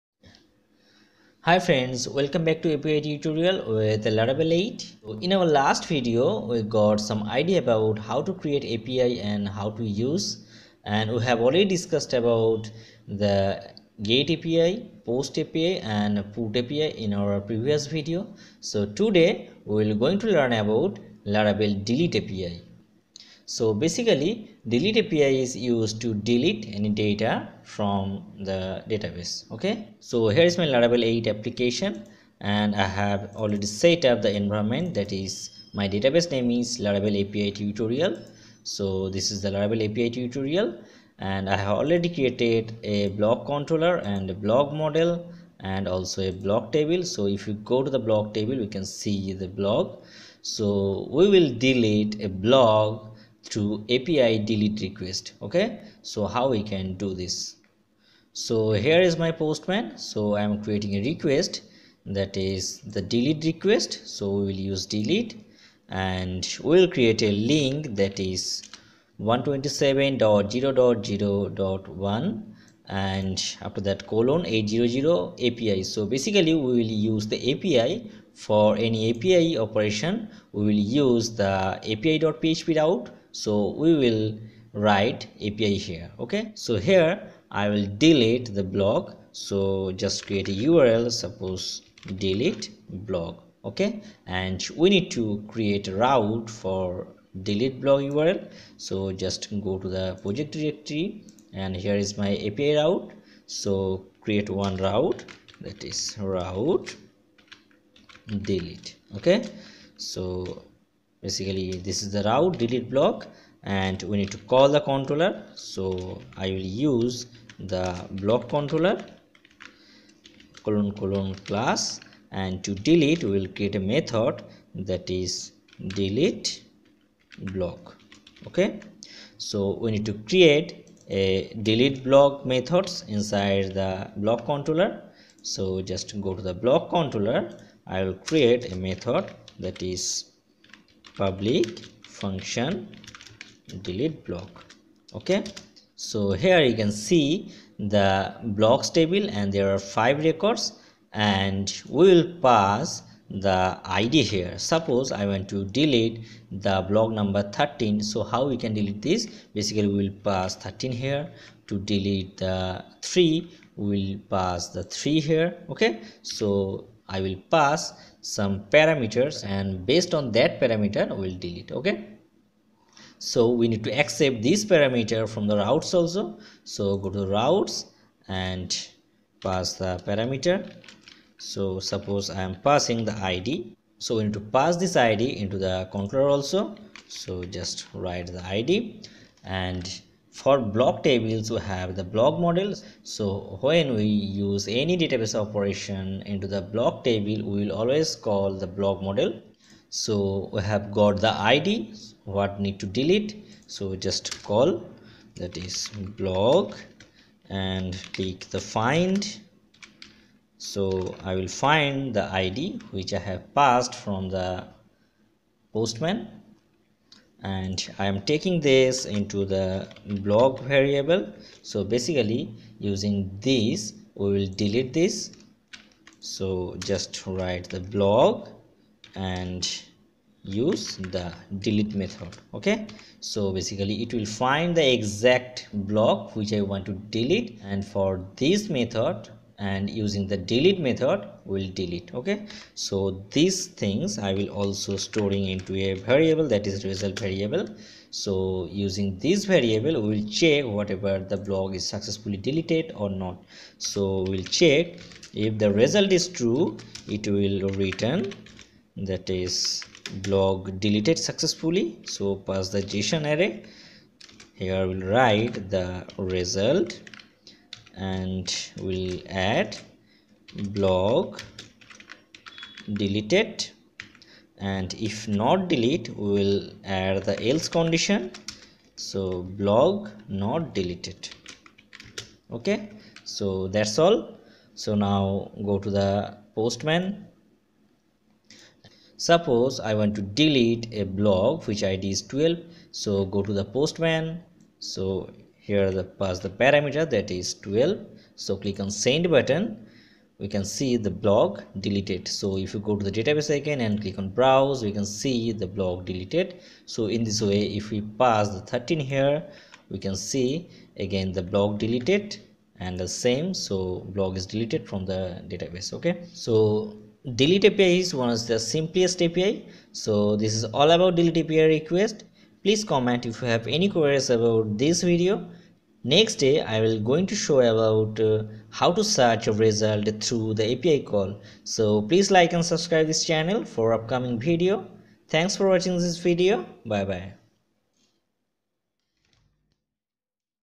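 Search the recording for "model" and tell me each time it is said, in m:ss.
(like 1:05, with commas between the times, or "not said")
0:44, 3:12, 3:19.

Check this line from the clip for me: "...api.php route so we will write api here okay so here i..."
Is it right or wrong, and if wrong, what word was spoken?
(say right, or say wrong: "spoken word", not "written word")
right.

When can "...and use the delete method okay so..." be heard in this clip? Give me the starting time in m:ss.
3:49.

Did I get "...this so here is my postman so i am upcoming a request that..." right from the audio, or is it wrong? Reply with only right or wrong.
wrong.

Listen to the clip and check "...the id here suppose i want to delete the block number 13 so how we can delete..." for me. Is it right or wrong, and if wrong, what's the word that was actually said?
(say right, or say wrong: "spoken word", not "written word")
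right.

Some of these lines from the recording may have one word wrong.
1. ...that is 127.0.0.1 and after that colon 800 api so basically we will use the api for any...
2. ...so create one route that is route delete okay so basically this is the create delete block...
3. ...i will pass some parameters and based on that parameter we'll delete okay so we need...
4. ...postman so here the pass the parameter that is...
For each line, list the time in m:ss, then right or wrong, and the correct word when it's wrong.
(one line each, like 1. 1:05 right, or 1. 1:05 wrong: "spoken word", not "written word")
1. 1:07 right
2. 1:43 wrong: "route", not "create"
3. 2:47 right
4. 4:53 right.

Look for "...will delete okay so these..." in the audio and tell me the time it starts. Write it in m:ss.
4:01.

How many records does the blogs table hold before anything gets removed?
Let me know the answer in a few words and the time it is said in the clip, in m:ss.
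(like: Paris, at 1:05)
5, at 2:29.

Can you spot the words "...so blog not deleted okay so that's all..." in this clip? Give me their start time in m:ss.
4:38.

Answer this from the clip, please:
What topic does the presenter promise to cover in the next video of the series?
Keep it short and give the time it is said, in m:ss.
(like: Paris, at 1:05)
search a result through the API, at 5:29.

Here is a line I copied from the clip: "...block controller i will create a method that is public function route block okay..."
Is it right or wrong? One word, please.
wrong.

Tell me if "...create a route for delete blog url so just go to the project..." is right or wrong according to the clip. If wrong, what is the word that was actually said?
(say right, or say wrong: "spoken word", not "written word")
right.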